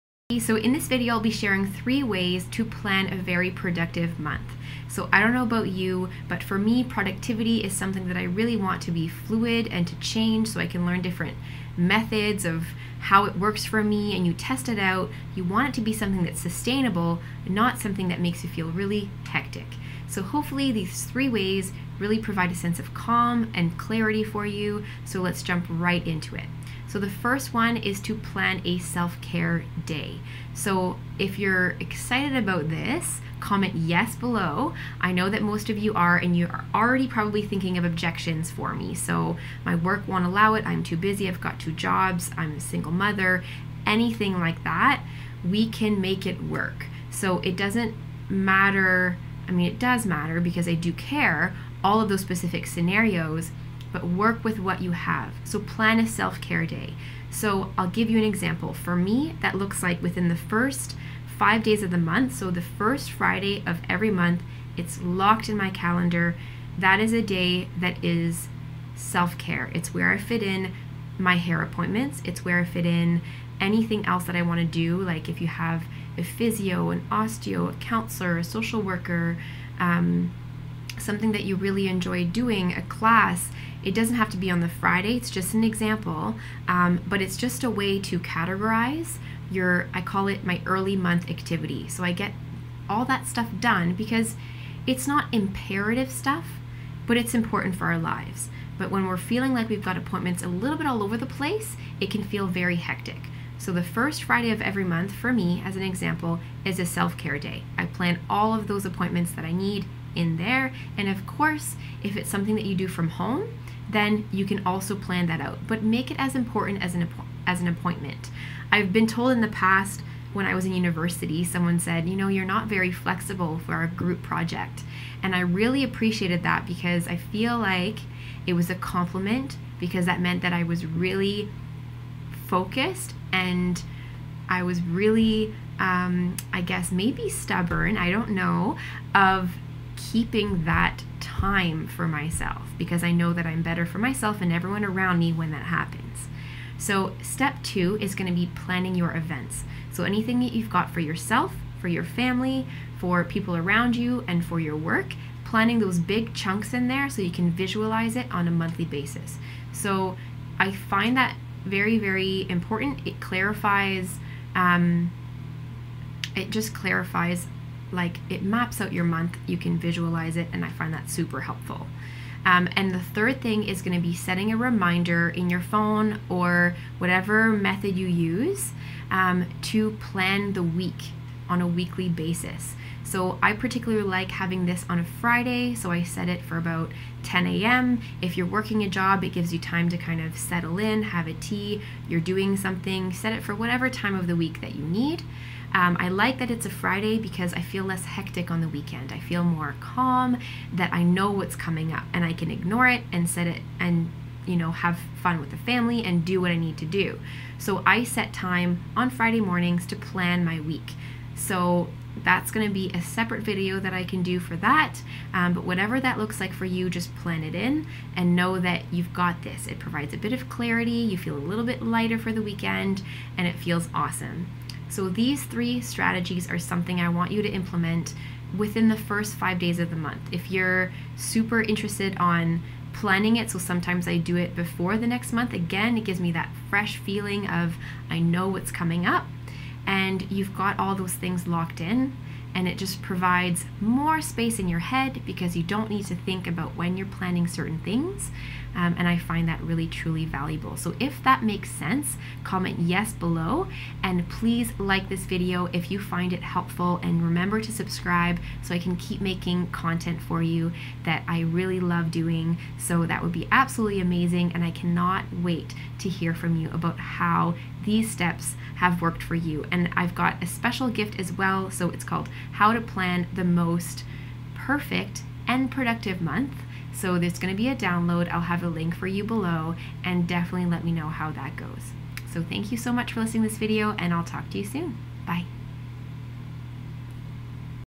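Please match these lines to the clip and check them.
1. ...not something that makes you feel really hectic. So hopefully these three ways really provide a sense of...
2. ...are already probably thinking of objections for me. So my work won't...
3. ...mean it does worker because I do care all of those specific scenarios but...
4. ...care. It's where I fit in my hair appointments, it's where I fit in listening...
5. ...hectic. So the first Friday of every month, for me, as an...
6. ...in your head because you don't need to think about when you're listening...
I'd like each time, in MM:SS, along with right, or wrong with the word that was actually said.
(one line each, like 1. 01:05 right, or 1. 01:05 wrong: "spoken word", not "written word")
1. 00:17 right
2. 00:36 right
3. 00:49 wrong: "matter", not "worker"
4. 01:09 wrong: "anything", not "listening"
5. 01:42 right
6. 04:04 wrong: "planning", not "listening".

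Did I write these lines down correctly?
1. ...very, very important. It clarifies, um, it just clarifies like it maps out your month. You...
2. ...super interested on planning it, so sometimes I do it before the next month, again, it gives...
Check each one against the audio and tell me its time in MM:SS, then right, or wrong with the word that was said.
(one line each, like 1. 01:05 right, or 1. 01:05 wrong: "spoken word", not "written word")
1. 02:41 right
2. 03:51 right.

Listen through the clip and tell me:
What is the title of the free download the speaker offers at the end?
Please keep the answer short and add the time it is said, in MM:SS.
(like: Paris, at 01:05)
How to Plan the Most Perfect and Productive Month, at 04:32.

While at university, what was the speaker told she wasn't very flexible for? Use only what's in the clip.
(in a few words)
A group project.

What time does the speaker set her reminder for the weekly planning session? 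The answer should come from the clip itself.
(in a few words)
10 a.m.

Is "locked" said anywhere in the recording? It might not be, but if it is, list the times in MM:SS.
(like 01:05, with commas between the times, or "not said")
01:05, 04:01.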